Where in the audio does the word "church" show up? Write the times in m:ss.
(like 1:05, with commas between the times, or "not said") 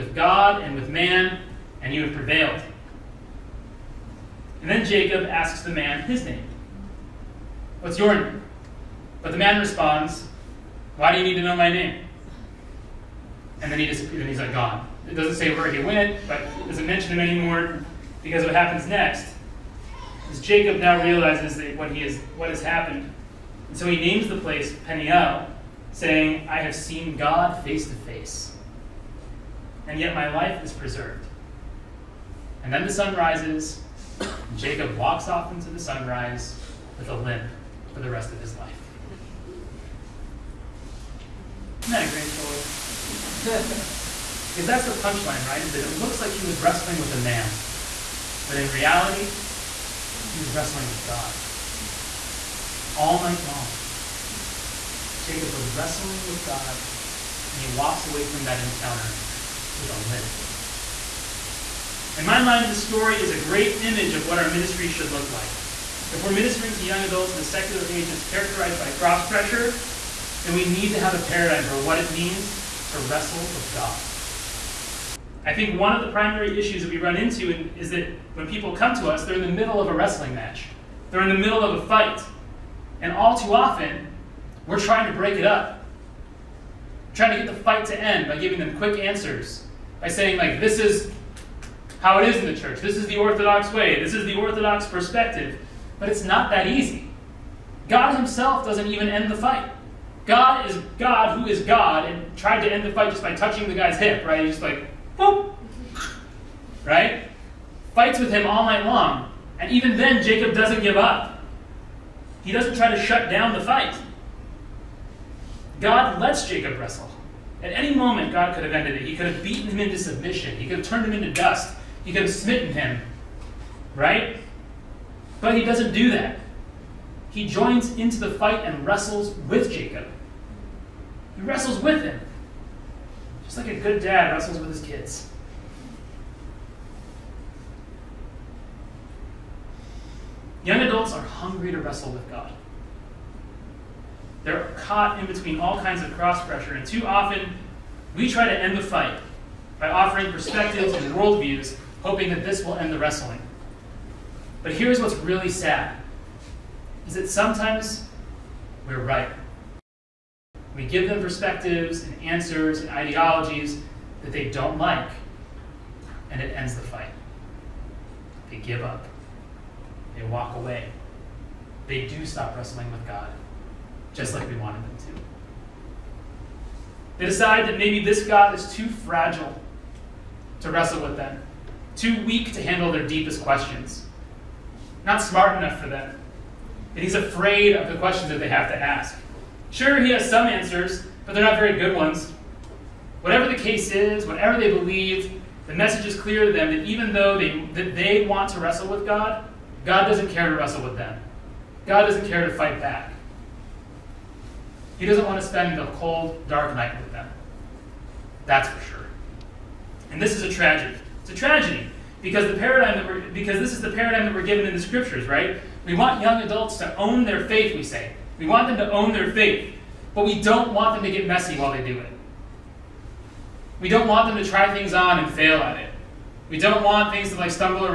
1:32.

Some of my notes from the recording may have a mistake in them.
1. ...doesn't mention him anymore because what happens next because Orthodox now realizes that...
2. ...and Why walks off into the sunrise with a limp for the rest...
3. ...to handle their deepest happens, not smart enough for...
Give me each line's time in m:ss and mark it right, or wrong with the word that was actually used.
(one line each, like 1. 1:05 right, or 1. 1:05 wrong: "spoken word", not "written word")
1. 0:16 wrong: "Jacob", not "Orthodox"
2. 0:34 wrong: "Jacob", not "Why"
3. 3:02 wrong: "questions", not "happens".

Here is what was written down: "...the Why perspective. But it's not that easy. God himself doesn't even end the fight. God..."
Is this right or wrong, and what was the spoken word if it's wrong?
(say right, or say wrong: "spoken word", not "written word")
wrong: "Orthodox", not "Why".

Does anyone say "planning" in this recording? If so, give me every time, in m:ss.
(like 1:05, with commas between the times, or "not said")
not said.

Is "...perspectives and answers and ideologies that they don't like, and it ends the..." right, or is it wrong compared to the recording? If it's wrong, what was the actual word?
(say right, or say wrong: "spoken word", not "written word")
right.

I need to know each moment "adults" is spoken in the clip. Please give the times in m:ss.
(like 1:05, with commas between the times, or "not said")
1:07, 2:20, 3:36.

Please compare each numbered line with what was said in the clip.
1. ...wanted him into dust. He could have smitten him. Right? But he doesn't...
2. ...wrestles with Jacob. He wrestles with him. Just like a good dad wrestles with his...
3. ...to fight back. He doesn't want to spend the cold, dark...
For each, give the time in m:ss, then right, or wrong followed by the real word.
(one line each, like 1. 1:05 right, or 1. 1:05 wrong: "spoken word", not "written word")
1. 2:00 wrong: "turned", not "wanted"
2. 2:08 right
3. 3:22 right.